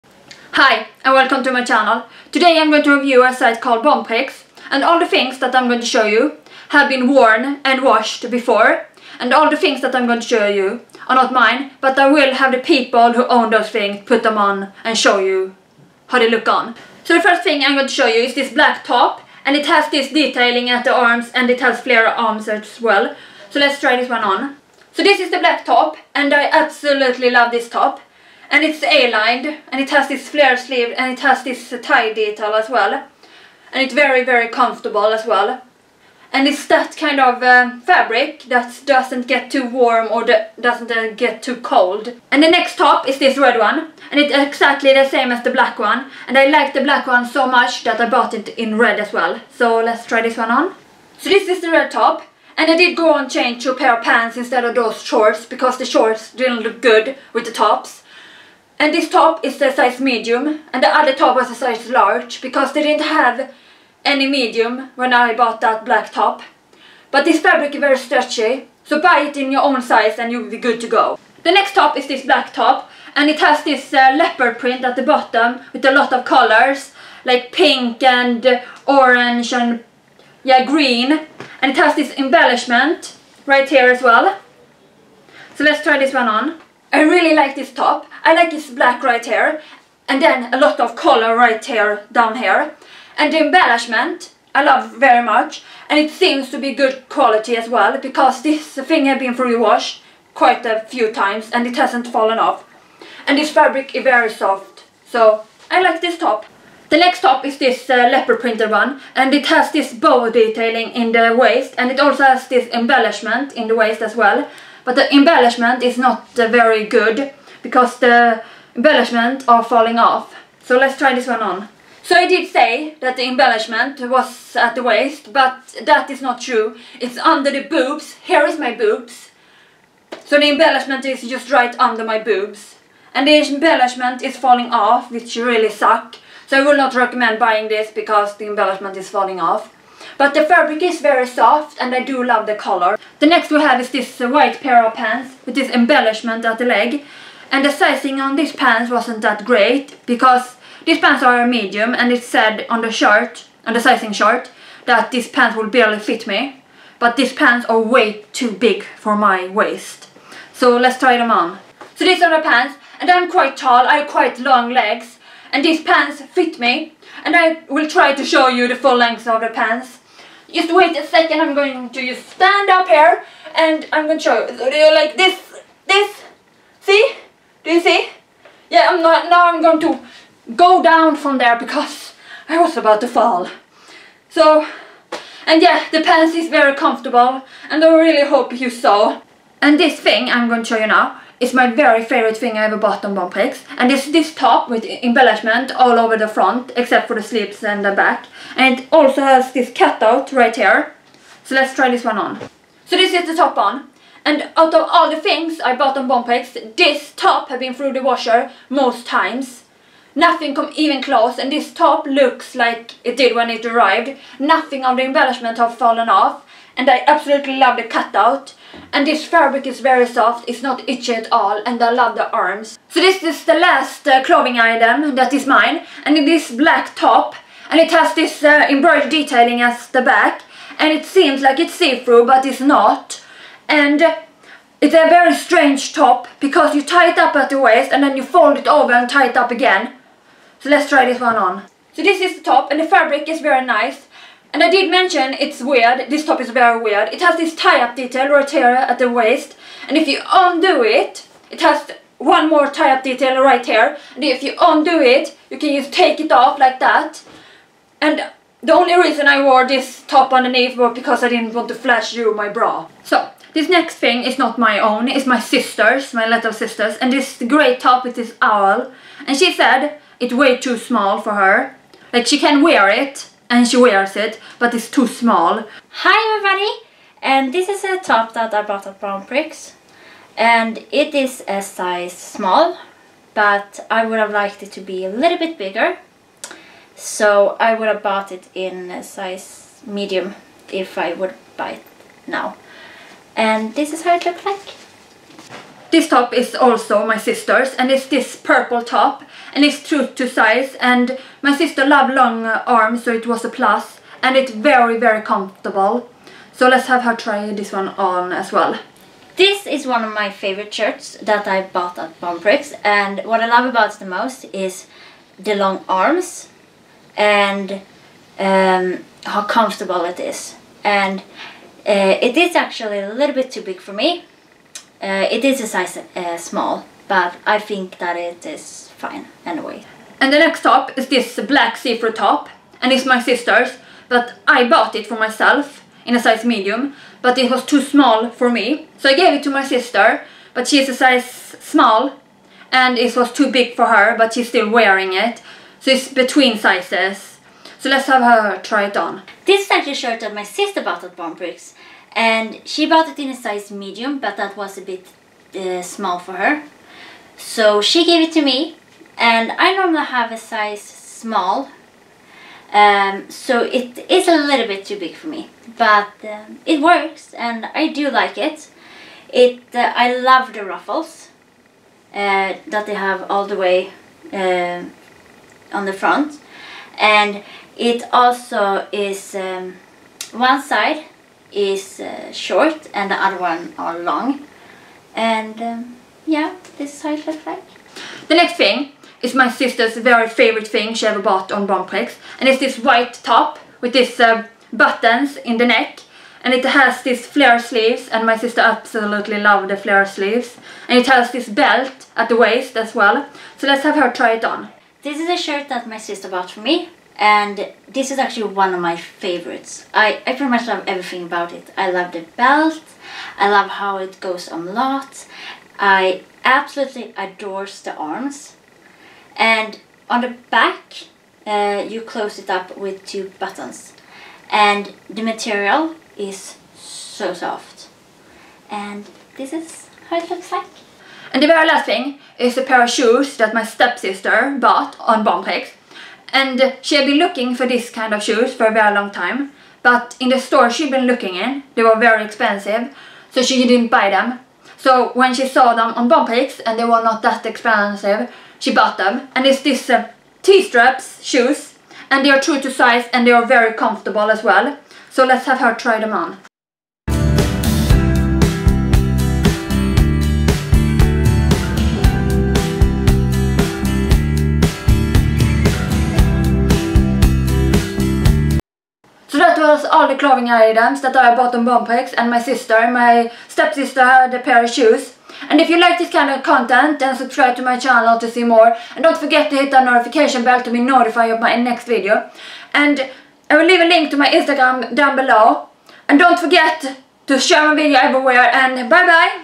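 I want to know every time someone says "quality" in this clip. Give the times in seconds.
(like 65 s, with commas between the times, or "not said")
97 s.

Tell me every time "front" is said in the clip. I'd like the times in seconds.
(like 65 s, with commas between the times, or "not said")
196 s, 375 s.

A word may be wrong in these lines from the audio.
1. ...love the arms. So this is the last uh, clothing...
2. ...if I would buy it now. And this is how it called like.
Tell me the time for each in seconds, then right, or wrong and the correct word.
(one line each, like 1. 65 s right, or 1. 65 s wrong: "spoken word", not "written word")
1. 221 s right
2. 290 s wrong: "looked", not "called".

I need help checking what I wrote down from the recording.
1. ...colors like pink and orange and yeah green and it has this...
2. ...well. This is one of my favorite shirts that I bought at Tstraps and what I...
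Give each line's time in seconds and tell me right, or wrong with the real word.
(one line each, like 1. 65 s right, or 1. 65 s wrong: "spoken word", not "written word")
1. 76 s right
2. 308 s wrong: "Bonprix", not "Tstraps".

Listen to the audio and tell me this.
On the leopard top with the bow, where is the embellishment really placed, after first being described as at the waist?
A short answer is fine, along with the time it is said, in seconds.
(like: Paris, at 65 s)
under the boobs, at 127 s.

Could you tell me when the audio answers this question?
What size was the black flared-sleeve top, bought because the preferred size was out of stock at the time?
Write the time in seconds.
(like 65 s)
61 s.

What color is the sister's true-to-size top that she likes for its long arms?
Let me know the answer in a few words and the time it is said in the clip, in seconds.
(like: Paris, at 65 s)
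purple, at 298 s.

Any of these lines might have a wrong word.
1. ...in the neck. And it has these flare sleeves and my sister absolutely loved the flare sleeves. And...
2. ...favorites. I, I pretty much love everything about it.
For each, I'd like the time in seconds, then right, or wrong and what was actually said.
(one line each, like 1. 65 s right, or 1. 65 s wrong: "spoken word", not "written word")
1. 395 s right
2. 408 s right.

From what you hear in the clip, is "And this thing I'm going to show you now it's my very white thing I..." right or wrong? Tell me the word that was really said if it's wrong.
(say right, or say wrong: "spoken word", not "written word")
wrong: "favorite", not "white".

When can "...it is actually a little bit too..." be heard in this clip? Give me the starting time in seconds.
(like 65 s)
322 s.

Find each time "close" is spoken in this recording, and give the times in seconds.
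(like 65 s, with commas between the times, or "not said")
211 s, 422 s.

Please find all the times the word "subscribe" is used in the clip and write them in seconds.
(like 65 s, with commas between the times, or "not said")
477 s.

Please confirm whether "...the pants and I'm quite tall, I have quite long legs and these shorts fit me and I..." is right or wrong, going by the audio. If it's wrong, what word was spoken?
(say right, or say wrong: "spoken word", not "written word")
wrong: "pants", not "shorts".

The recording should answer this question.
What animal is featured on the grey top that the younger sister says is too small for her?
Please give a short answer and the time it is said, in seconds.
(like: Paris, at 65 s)
owl, at 268 s.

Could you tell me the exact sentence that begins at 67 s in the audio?
But this fabric is very stretchy, so buy it in your own size and you'll be good to go.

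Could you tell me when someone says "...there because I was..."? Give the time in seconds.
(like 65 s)
181 s.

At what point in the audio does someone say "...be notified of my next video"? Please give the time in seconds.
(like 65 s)
480 s.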